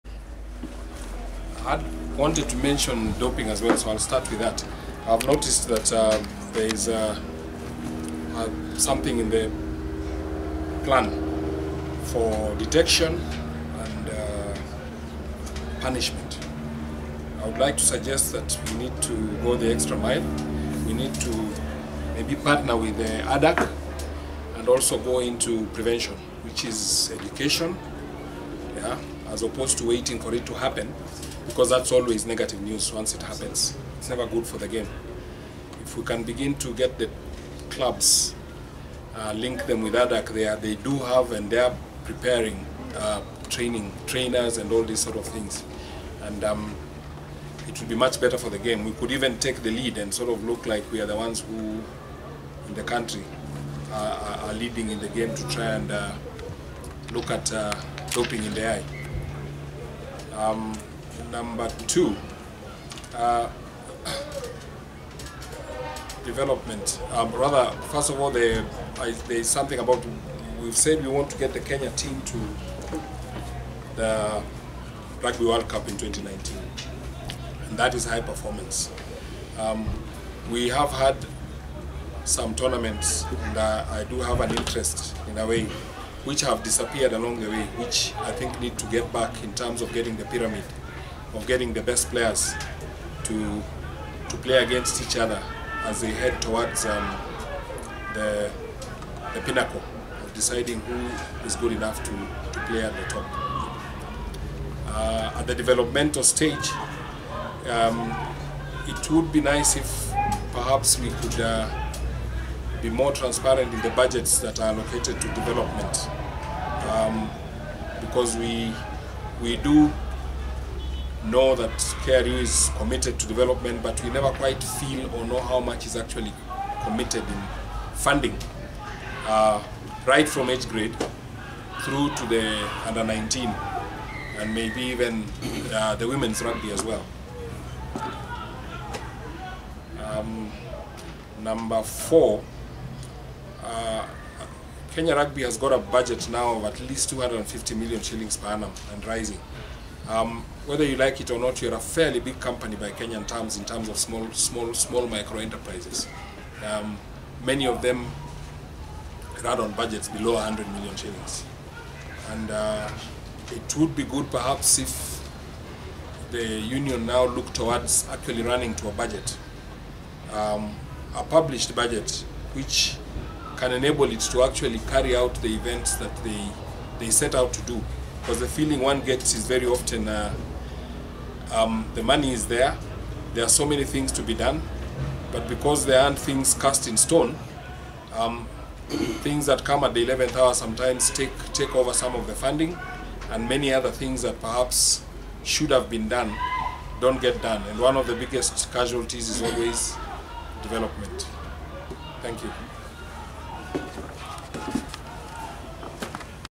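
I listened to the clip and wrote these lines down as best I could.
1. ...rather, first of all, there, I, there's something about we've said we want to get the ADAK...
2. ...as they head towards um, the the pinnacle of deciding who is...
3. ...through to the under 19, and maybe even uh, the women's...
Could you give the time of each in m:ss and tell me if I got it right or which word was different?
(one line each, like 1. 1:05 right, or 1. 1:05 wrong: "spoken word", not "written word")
1. 1:07 wrong: "Kenya", not "ADAK"
2. 1:35 right
3. 2:11 right.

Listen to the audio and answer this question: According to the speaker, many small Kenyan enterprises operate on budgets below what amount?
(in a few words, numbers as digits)
100 million shillings.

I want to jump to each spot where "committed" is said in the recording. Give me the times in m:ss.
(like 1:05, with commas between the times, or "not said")
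2:02, 2:06.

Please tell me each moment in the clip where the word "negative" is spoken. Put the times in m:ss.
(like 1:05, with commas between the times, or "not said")
0:32.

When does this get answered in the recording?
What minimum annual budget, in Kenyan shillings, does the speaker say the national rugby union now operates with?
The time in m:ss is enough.
2:27.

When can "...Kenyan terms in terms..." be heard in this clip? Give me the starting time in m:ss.
2:32.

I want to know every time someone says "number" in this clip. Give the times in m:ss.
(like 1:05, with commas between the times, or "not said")
1:01, 2:21.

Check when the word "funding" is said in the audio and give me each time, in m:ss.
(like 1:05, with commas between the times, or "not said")
2:07, 3:12.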